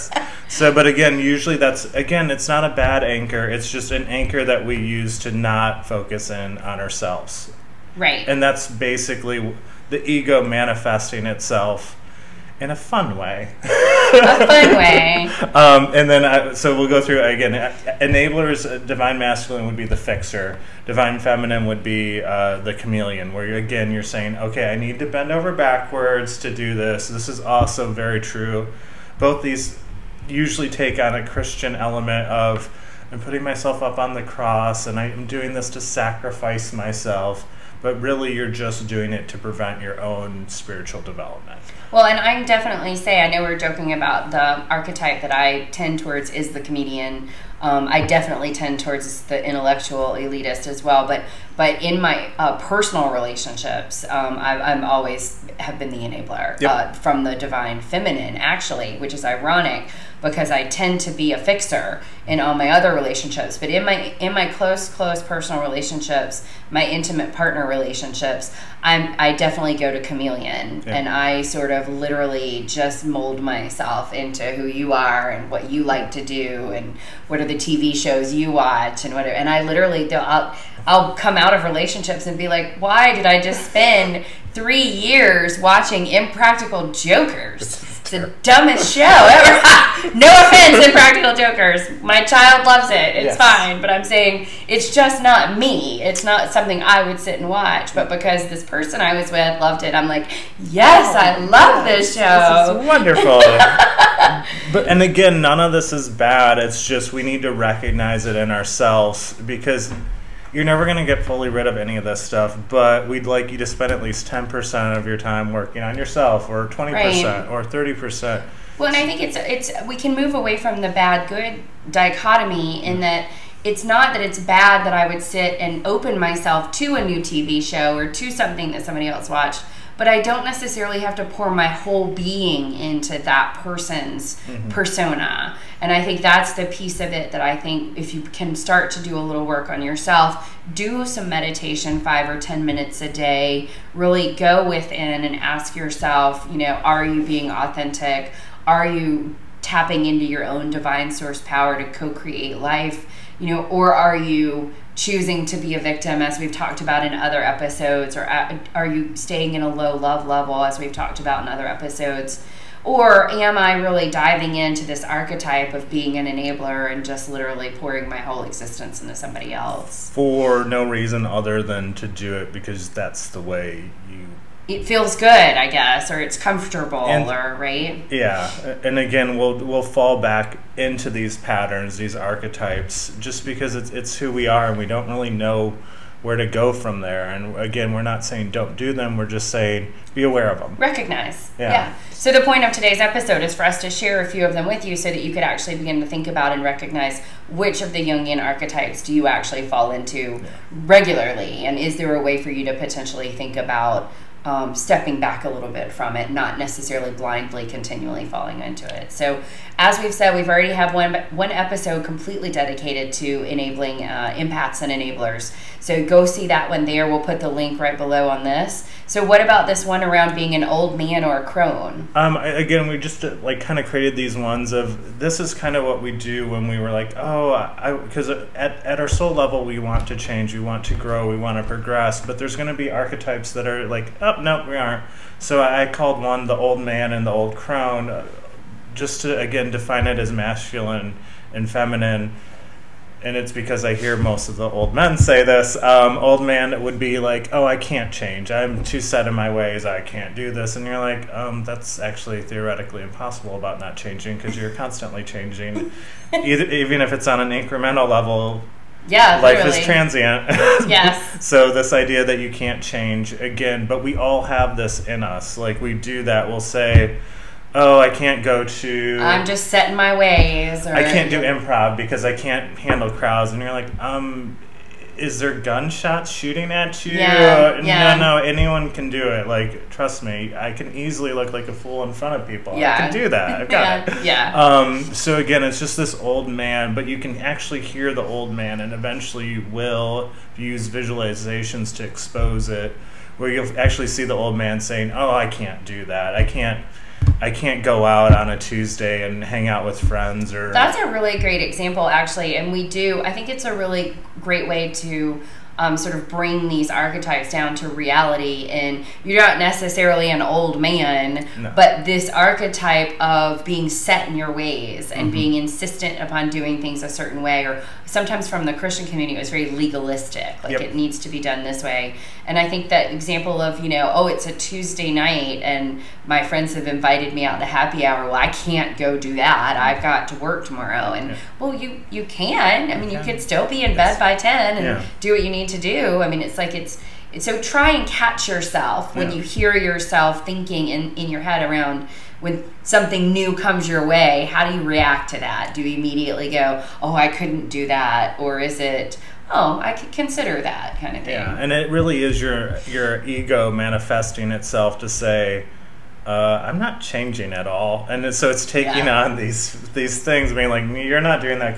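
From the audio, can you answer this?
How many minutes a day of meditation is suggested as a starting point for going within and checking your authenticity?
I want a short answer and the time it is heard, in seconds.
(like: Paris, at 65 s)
5 or 10, at 142 s.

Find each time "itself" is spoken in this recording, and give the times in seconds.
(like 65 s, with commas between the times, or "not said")
11 s, 354 s.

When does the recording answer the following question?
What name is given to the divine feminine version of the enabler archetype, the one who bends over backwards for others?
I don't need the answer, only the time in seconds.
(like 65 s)
22 s.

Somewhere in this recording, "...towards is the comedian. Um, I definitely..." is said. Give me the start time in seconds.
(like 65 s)
45 s.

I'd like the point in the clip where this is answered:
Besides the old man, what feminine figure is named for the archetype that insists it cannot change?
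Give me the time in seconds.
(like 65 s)
237 s.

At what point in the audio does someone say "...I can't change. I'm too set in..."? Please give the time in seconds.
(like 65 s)
247 s.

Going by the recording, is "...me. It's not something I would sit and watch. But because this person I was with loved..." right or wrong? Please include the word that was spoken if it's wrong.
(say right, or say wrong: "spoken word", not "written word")
right.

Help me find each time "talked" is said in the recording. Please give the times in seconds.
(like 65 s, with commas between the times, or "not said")
156 s, 160 s.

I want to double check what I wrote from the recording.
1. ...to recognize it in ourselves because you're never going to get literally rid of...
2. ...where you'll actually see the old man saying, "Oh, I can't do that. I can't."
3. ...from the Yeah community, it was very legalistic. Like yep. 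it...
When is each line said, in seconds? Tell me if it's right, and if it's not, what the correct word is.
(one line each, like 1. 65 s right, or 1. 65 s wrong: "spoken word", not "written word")
1. 107 s wrong: "fully", not "literally"
2. 293 s right
3. 318 s wrong: "Christian", not "Yeah".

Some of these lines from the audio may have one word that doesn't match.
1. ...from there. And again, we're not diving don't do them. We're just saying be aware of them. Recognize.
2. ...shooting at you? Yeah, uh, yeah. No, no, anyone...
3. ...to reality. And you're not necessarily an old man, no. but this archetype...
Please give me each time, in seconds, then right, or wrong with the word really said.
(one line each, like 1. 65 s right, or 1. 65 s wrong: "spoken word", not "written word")
1. 186 s wrong: "saying", not "diving"
2. 276 s right
3. 307 s right.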